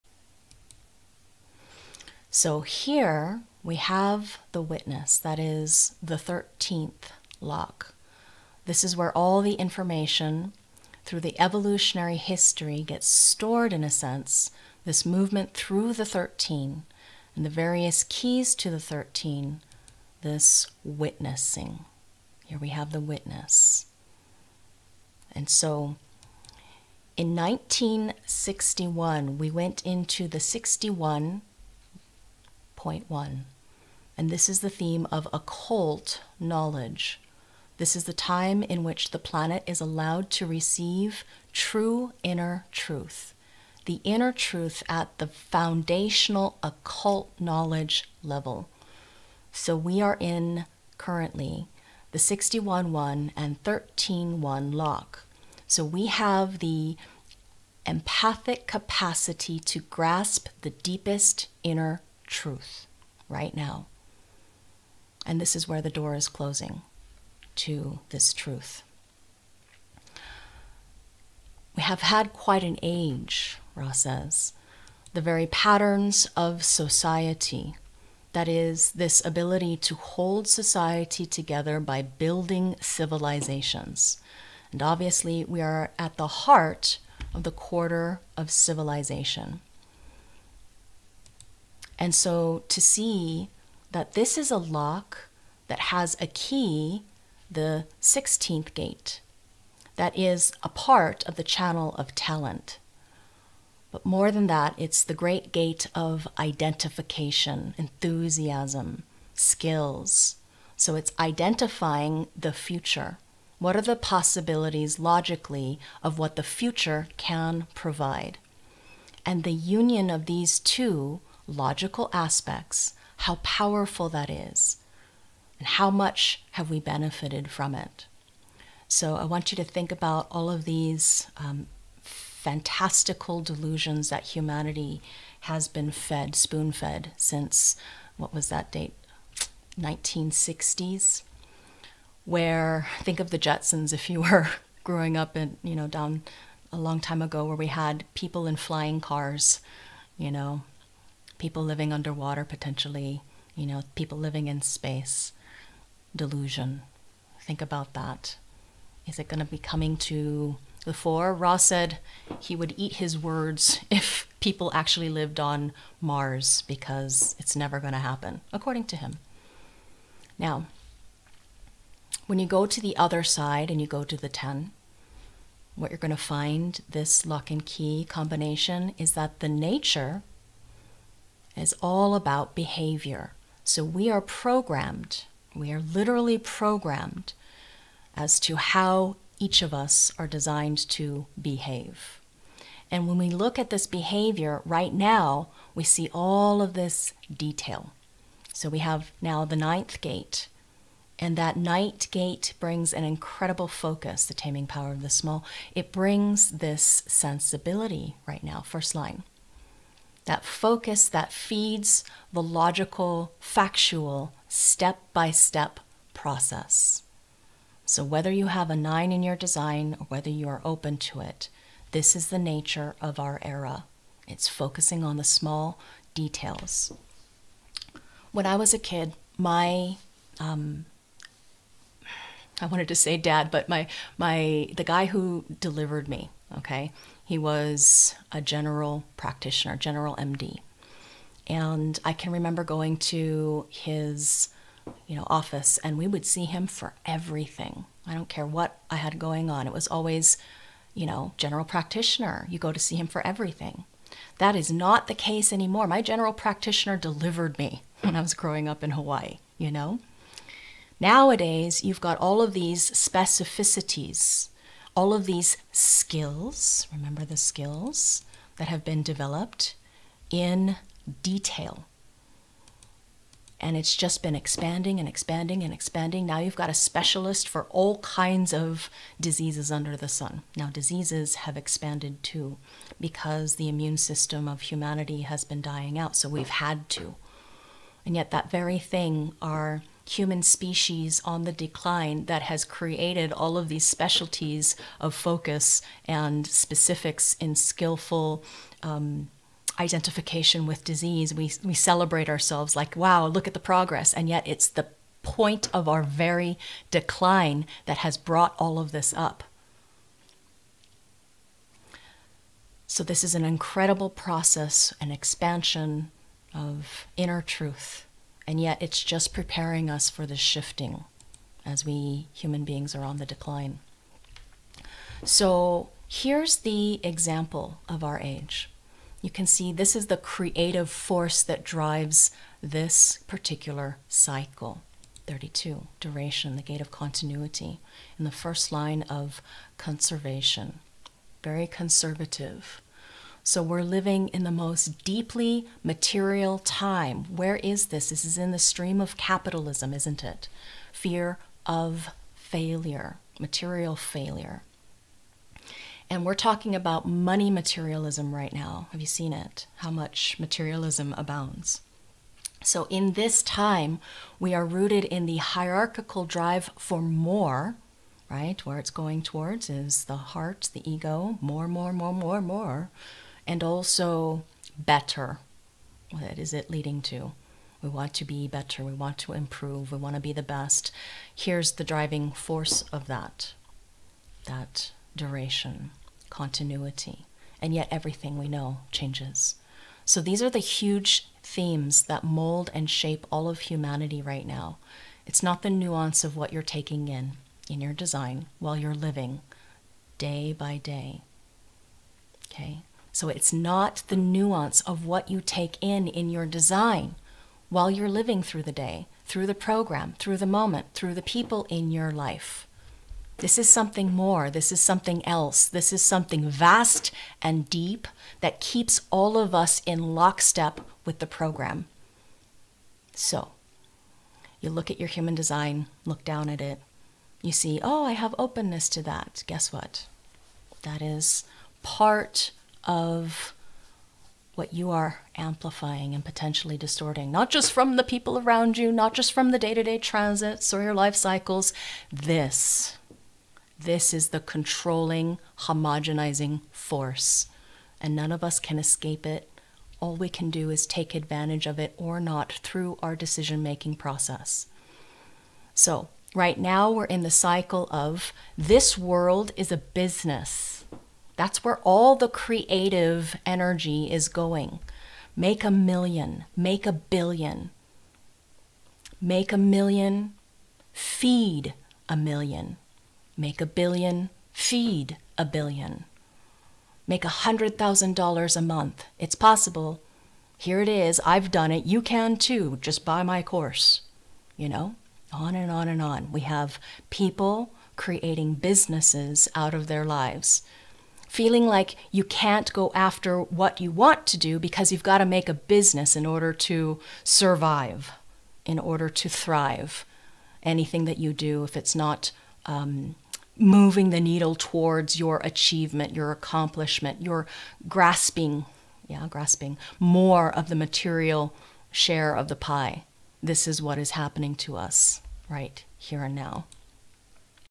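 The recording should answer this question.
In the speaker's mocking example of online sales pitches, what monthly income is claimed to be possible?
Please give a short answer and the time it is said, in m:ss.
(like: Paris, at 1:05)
$100,000 a month, at 7:57.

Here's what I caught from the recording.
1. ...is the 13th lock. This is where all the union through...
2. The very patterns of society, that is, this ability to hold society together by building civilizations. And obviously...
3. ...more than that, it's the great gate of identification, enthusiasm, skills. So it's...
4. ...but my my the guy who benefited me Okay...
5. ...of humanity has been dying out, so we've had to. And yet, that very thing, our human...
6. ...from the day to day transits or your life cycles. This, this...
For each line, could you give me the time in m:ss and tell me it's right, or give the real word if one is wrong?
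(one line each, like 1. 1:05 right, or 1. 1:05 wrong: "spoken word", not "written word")
1. 0:05 wrong: "information", not "union"
2. 1:15 right
3. 1:44 right
4. 3:53 wrong: "delivered", not "benefited"
5. 4:44 right
6. 7:19 right.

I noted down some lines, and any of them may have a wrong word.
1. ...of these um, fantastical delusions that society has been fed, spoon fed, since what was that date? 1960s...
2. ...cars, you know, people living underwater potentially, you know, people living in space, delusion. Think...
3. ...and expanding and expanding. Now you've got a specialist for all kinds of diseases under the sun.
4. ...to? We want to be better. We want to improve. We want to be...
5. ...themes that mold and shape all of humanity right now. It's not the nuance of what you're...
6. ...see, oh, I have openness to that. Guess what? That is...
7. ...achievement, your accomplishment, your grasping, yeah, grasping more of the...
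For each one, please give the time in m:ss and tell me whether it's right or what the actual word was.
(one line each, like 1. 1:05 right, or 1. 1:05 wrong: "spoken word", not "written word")
1. 2:10 wrong: "humanity", not "society"
2. 2:28 right
3. 4:34 right
4. 6:17 right
5. 6:31 right
6. 7:07 right
7. 8:25 right.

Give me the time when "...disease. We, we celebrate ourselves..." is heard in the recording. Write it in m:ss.
5:00.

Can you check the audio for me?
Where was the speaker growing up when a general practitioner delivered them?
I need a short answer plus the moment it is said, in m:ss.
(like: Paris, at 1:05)
Hawaii, at 4:18.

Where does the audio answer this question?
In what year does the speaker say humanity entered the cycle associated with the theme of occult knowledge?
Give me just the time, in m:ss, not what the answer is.
0:27.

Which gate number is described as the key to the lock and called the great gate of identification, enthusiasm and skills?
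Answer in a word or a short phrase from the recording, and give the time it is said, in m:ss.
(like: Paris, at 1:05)
16, at 1:37.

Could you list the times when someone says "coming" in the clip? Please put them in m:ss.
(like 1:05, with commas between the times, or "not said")
2:39.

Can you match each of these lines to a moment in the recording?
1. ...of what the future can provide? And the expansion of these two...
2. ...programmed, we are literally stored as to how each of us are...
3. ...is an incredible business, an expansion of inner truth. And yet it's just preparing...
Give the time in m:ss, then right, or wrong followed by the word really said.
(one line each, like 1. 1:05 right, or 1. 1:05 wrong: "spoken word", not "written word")
1. 1:56 wrong: "union", not "expansion"
2. 3:04 wrong: "programmed", not "stored"
3. 5:13 wrong: "process", not "business".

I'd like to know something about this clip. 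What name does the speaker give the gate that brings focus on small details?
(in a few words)
The taming power of the small.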